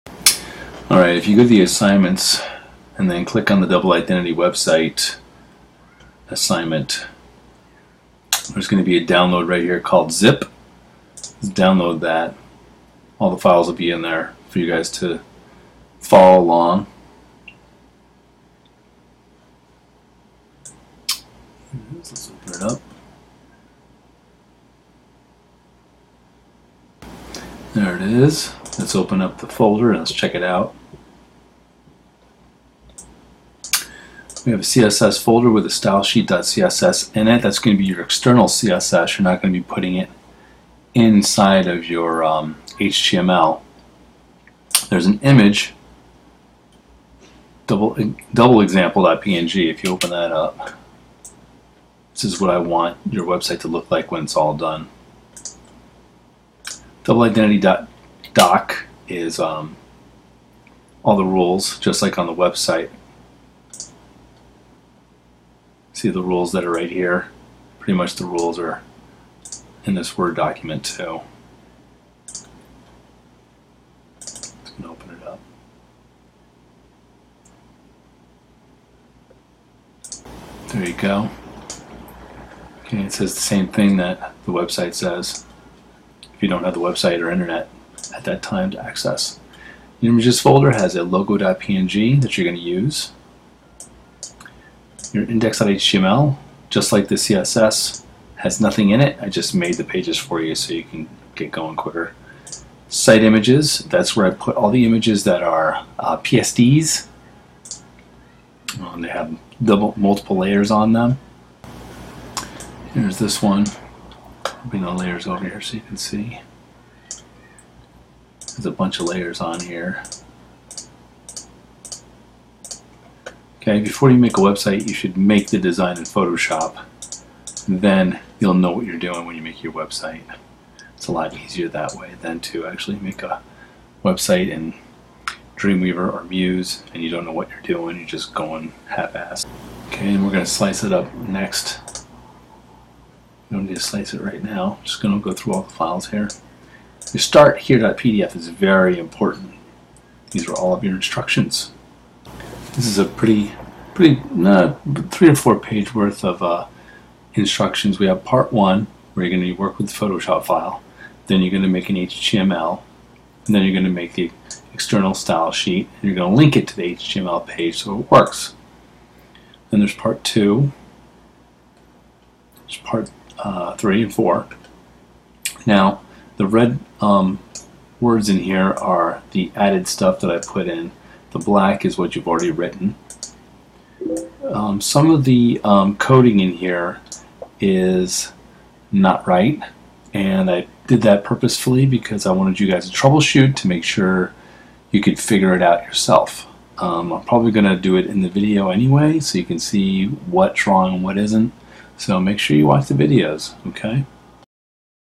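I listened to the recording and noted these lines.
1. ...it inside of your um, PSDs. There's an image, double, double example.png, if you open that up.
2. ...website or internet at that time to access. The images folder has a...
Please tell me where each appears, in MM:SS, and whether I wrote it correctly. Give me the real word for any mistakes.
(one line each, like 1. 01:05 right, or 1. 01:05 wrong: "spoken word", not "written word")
1. 00:39 wrong: "HTML", not "PSDs"
2. 01:26 right.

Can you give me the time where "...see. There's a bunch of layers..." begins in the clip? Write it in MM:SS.
01:55.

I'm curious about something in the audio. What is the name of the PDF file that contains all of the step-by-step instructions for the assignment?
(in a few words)
start here.pdf.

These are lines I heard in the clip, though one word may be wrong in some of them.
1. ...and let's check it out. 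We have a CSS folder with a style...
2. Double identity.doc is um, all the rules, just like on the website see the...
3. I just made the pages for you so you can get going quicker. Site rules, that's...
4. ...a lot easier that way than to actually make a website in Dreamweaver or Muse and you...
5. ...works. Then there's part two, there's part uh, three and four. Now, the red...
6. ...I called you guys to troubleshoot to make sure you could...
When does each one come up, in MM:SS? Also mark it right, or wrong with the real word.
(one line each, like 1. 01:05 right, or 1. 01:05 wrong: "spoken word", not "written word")
1. 00:29 right
2. 00:57 right
3. 01:39 wrong: "images", not "rules"
4. 02:11 right
5. 02:48 right
6. 03:12 wrong: "wanted", not "called".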